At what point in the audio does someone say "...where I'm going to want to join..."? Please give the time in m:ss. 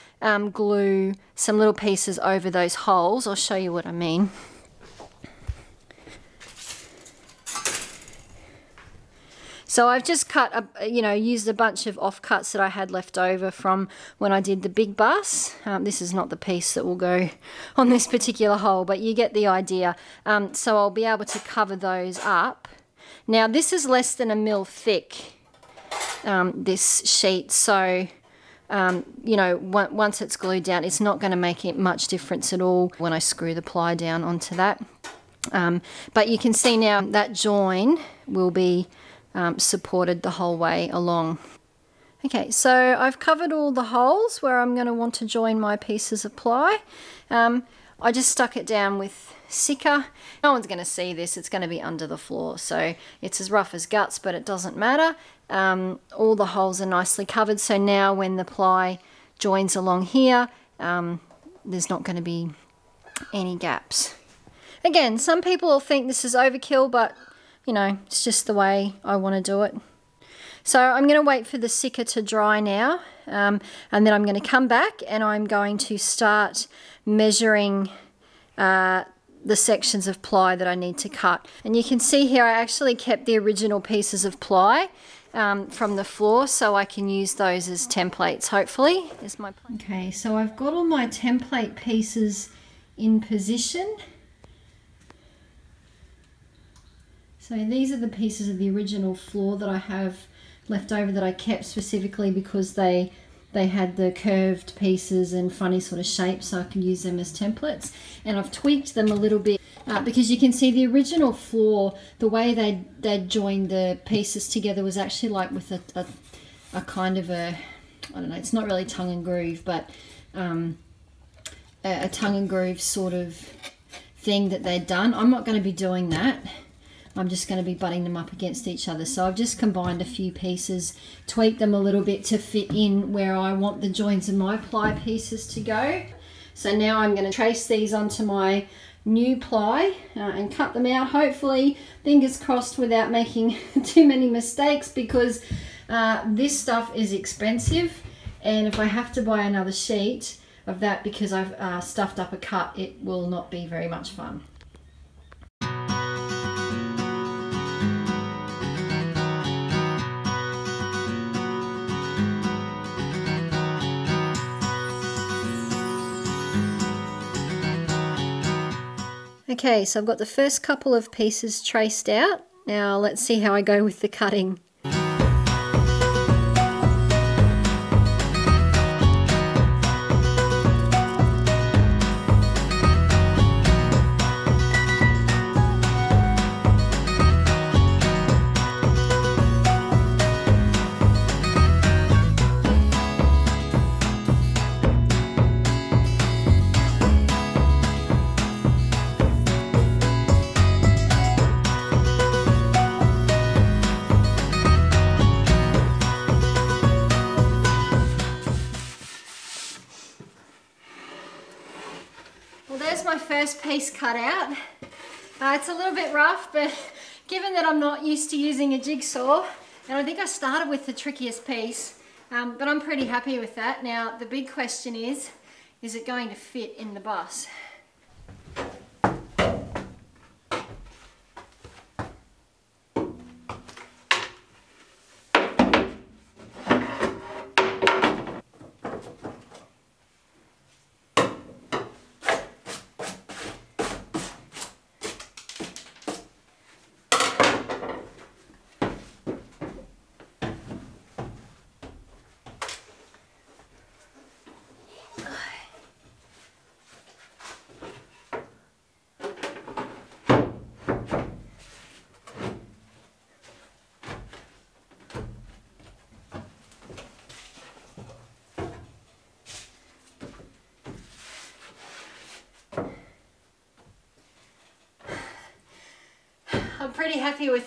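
0:44.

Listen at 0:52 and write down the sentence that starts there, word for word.
So it's as rough as guts, but it doesn't matter.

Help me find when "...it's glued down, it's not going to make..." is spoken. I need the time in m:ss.
0:30.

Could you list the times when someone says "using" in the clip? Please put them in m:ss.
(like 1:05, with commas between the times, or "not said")
3:38.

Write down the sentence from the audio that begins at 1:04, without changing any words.
Again, some people will think this is overkill, but you know, it's just the way I want to do it.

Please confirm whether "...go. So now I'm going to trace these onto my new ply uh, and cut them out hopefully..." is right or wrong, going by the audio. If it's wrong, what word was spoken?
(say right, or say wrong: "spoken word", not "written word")
right.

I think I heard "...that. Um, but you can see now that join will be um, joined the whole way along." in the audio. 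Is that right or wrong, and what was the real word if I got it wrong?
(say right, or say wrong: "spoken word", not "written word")
wrong: "supported", not "joined".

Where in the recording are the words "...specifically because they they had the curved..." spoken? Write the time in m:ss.
1:41.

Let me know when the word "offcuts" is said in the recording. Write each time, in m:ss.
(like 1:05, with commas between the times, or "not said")
0:11.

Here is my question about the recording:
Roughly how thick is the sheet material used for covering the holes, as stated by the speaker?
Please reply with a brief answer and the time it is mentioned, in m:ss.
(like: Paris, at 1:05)
Less than 1 mm, at 0:23.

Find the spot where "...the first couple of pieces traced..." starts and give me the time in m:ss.
2:50.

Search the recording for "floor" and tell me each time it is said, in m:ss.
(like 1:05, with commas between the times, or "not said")
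0:52, 1:26, 1:39, 1:51.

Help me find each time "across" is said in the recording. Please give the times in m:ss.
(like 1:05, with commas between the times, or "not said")
not said.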